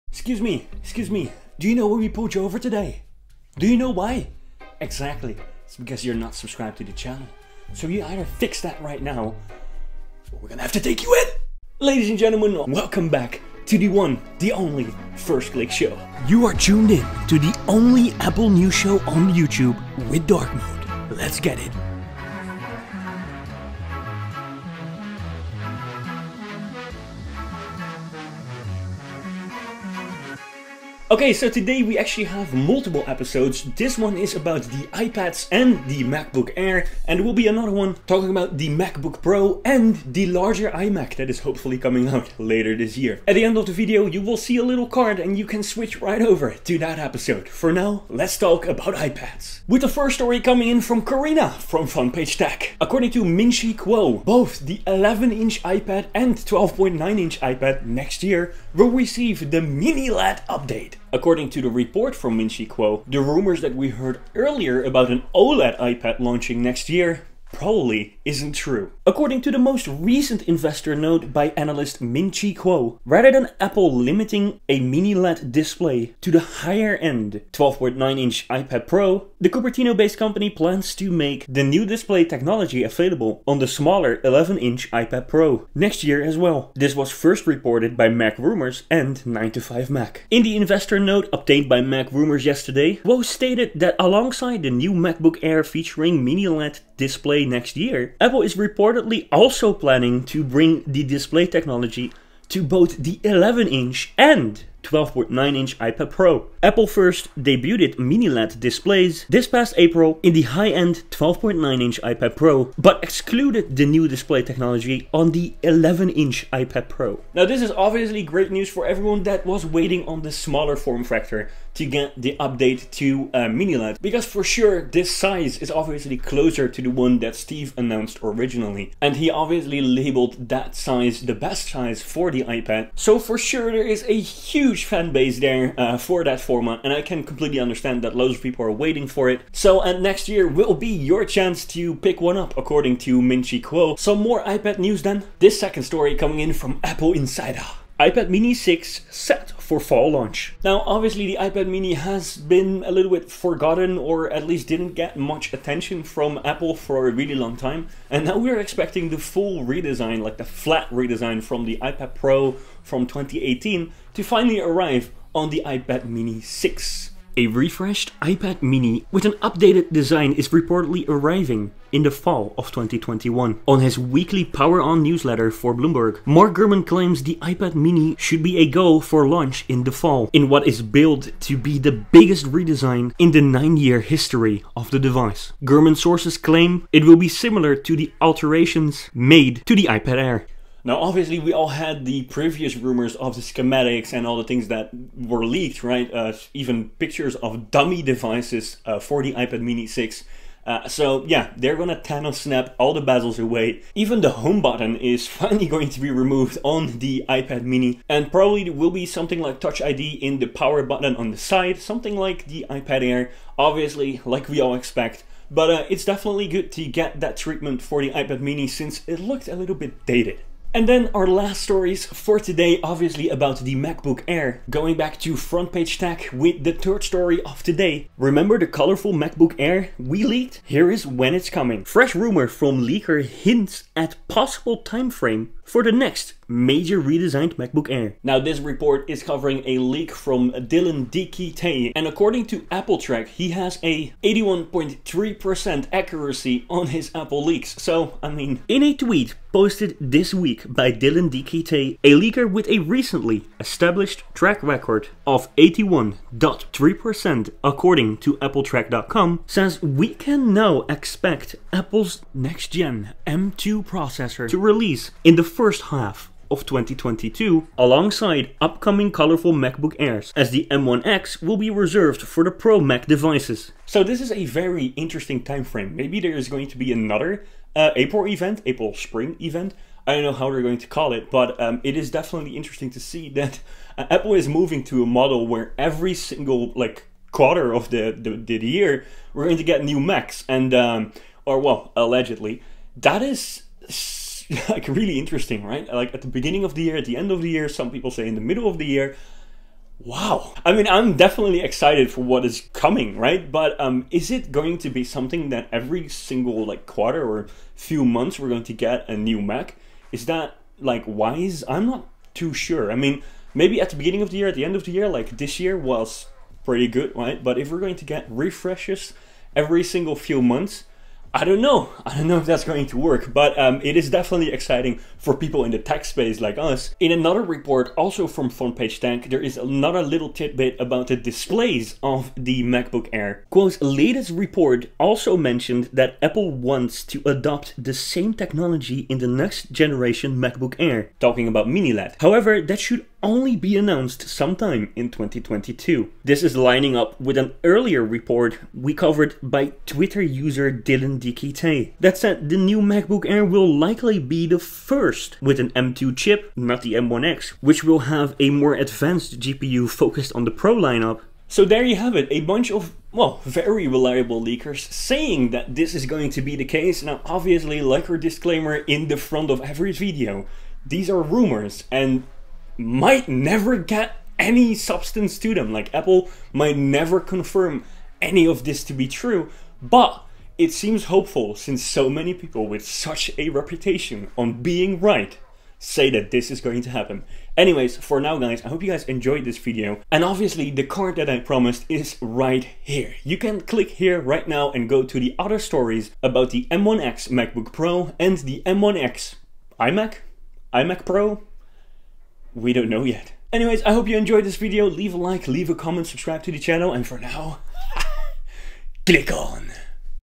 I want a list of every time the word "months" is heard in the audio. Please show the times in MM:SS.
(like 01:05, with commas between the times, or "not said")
05:08, 05:20.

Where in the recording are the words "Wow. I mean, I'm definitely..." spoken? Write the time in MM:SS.
04:59.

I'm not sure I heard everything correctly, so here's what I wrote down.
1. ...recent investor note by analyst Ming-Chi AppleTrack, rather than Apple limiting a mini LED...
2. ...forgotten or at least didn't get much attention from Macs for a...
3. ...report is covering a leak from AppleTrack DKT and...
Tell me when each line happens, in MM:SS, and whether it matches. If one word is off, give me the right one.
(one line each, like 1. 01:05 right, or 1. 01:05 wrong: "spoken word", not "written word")
1. 01:09 wrong: "Kuo", not "AppleTrack"
2. 02:33 wrong: "Apple", not "Macs"
3. 03:58 wrong: "Dylan", not "AppleTrack".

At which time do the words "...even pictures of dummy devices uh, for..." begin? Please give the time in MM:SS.
03:16.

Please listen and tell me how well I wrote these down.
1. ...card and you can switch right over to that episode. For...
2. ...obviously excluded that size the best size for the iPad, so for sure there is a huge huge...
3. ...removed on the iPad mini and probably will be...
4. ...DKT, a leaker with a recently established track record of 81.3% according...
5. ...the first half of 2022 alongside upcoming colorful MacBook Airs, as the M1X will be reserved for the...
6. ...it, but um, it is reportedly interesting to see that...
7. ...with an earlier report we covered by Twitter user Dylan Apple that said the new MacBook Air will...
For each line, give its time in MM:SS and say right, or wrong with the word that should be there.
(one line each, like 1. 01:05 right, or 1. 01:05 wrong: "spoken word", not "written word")
1. 00:44 right
2. 02:09 wrong: "labeled", not "excluded"
3. 03:26 right
4. 04:11 right
5. 04:25 right
6. 04:41 wrong: "definitely", not "reportedly"
7. 05:47 wrong: "DKT", not "Apple".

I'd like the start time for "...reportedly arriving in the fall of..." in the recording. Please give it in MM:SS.
02:50.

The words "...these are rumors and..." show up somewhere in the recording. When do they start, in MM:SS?
06:10.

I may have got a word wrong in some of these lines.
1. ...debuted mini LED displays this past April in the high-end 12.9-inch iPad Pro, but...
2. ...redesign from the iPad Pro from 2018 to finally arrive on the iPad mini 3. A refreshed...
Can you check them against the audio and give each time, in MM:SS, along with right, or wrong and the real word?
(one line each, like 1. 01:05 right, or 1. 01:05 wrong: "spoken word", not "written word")
1. 01:47 right
2. 02:40 wrong: "6", not "3".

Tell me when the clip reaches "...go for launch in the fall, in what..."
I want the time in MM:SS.
02:58.